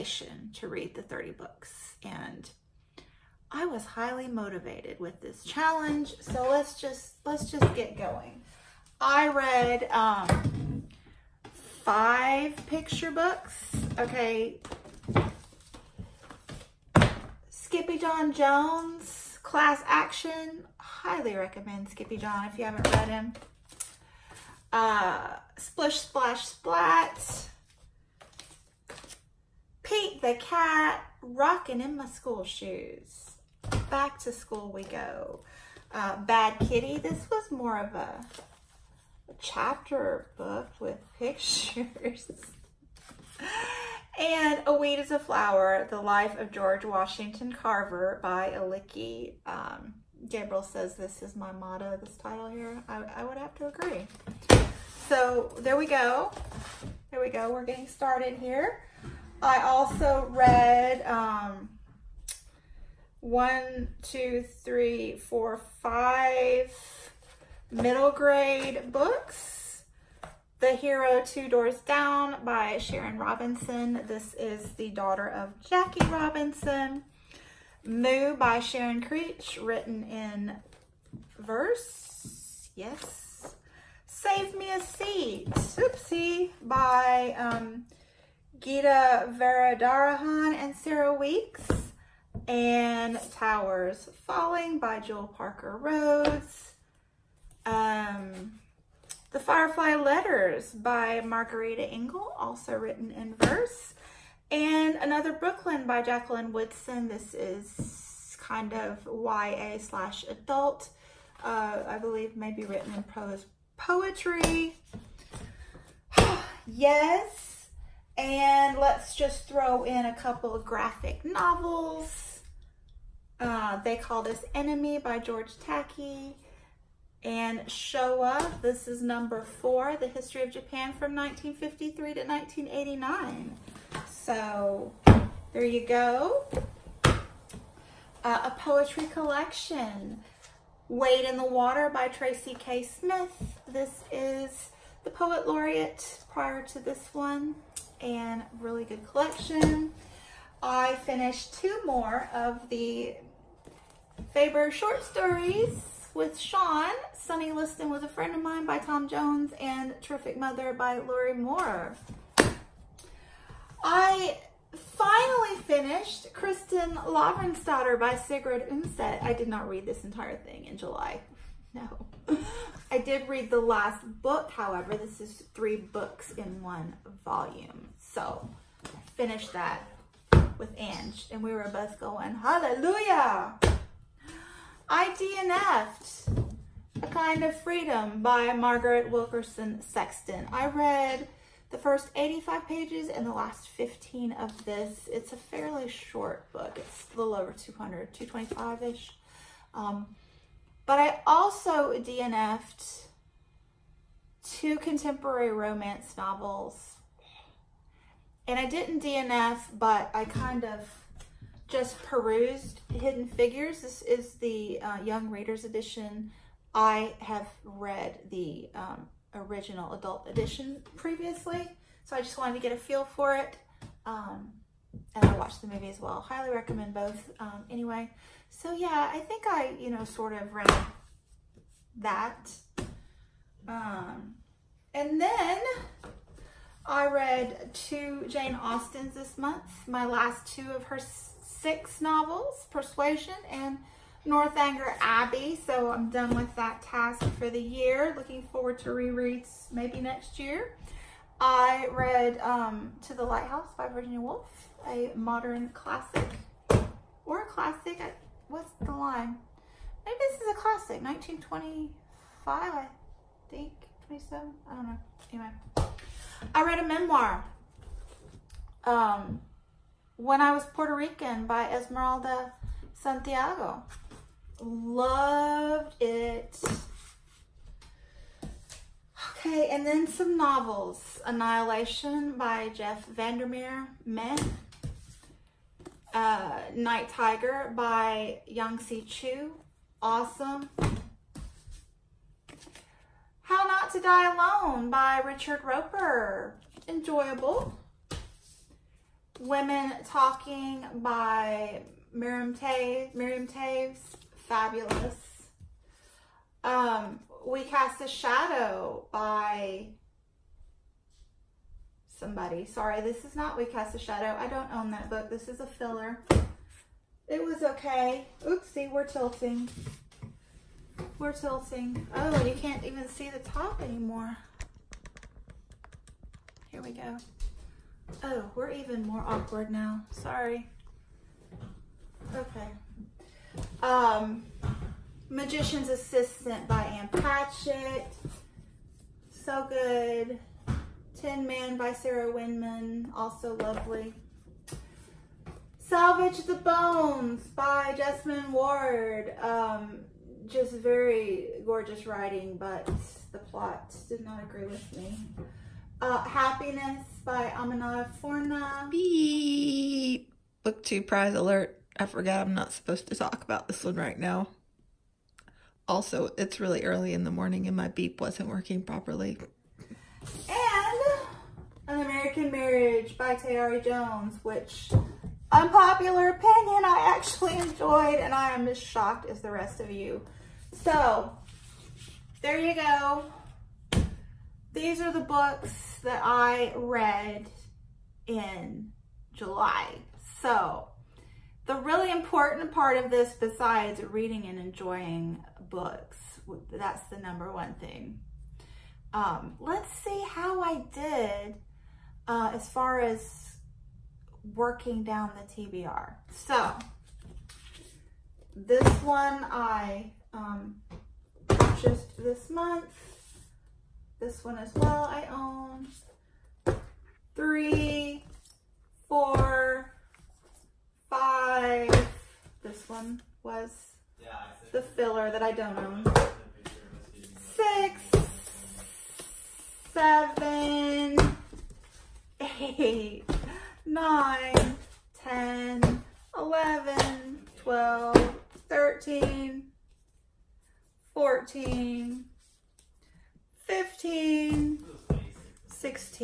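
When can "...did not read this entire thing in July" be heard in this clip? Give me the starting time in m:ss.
2:49.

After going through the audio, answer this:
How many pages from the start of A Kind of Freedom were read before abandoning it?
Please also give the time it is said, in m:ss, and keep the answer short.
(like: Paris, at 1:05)
85, at 3:12.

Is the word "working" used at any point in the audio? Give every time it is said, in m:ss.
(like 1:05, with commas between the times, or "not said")
6:08, 6:44.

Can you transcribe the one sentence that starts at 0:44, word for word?
and A Weed is a Flower, The Life of George Washington Carver by Aliki.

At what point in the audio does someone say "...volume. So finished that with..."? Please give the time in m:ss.
2:57.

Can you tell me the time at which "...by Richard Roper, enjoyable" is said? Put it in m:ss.
4:54.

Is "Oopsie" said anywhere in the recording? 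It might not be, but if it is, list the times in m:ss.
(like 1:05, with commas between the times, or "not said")
1:25, 5:18.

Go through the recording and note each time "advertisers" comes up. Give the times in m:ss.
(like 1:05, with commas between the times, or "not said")
not said.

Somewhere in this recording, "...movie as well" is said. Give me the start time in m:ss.
3:45.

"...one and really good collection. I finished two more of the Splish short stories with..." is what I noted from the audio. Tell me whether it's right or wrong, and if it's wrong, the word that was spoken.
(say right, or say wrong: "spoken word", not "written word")
wrong: "Faber", not "Splish".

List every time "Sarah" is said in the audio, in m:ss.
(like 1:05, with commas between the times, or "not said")
1:30, 5:41.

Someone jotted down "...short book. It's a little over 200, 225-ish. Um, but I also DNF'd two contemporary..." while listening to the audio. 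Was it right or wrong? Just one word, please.
right.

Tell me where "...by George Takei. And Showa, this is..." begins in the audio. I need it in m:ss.
2:04.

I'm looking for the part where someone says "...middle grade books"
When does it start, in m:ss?
1:07.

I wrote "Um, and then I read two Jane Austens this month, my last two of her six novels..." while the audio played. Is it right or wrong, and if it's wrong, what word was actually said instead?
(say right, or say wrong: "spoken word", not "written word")
right.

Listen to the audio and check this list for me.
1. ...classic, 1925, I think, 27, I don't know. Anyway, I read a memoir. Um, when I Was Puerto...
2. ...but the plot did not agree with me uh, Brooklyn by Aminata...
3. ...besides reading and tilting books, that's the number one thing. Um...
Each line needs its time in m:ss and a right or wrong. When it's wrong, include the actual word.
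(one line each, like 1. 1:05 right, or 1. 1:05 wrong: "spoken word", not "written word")
1. 4:20 right
2. 5:52 wrong: "Happiness", not "Brooklyn"
3. 6:33 wrong: "enjoying", not "tilting".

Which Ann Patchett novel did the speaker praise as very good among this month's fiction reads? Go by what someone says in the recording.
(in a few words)
Magician's Assistant.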